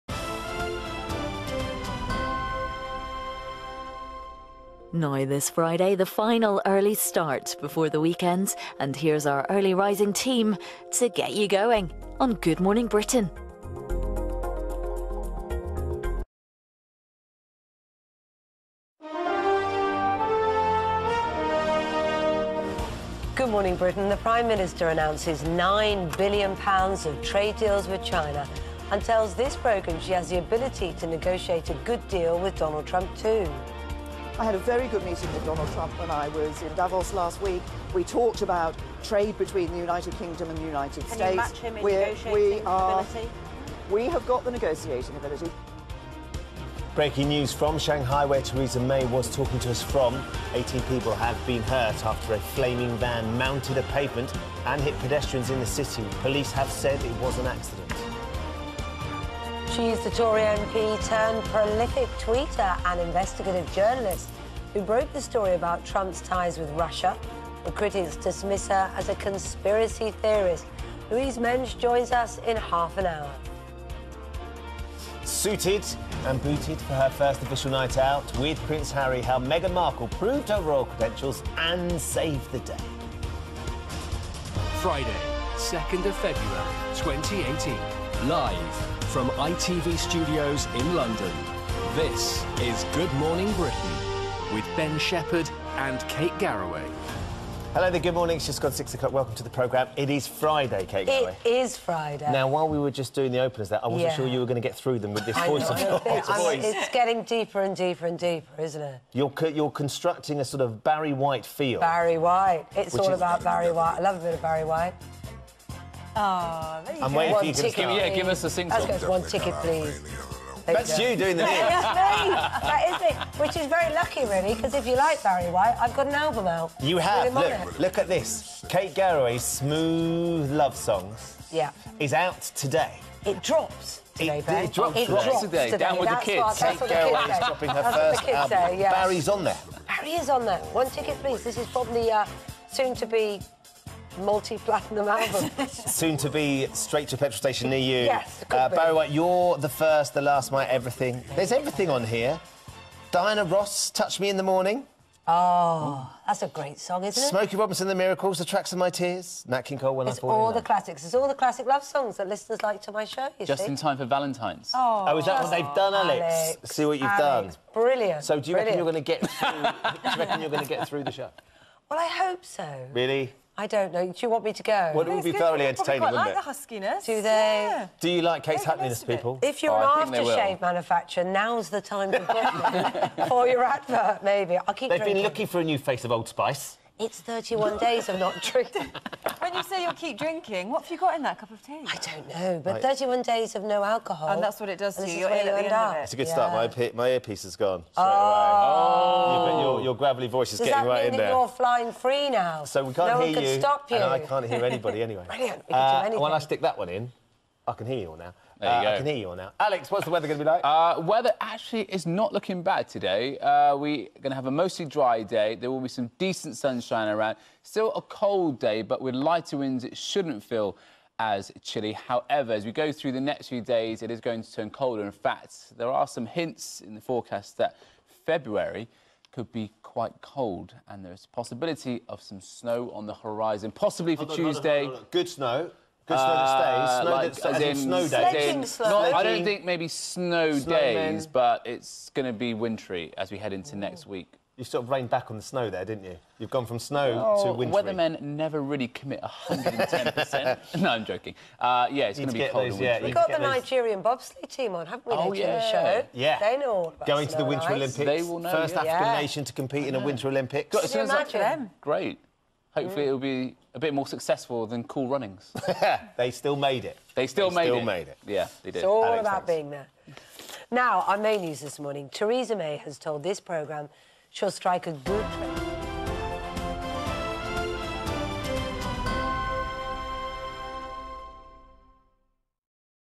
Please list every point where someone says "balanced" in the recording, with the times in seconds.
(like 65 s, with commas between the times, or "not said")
not said.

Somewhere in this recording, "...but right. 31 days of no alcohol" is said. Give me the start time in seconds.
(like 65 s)
192 s.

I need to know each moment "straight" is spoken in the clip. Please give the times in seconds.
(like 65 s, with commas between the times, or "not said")
146 s, 197 s.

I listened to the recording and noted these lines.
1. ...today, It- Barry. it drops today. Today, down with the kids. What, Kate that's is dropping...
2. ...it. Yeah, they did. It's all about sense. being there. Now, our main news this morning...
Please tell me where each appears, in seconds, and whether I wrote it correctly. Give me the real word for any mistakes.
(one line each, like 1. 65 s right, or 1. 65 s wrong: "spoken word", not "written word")
1. 134 s right
2. 268 s right.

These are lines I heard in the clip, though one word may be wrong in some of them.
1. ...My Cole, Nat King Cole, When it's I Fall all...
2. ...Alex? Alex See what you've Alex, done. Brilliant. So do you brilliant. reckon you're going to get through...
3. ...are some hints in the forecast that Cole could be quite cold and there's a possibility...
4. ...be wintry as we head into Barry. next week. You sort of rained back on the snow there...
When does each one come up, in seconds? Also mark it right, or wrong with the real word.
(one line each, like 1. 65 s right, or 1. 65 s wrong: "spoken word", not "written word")
1. 158 s wrong: "Tears", not "Cole"
2. 165 s right
3. 225 s wrong: "February", not "Cole"
4. 242 s wrong: "Ooh", not "Barry".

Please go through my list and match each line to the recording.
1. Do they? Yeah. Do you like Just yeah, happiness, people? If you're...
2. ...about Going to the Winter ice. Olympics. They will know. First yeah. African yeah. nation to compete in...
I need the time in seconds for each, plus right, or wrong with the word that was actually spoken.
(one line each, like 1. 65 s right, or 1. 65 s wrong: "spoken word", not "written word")
1. 177 s wrong: "Case", not "Just"
2. 256 s right.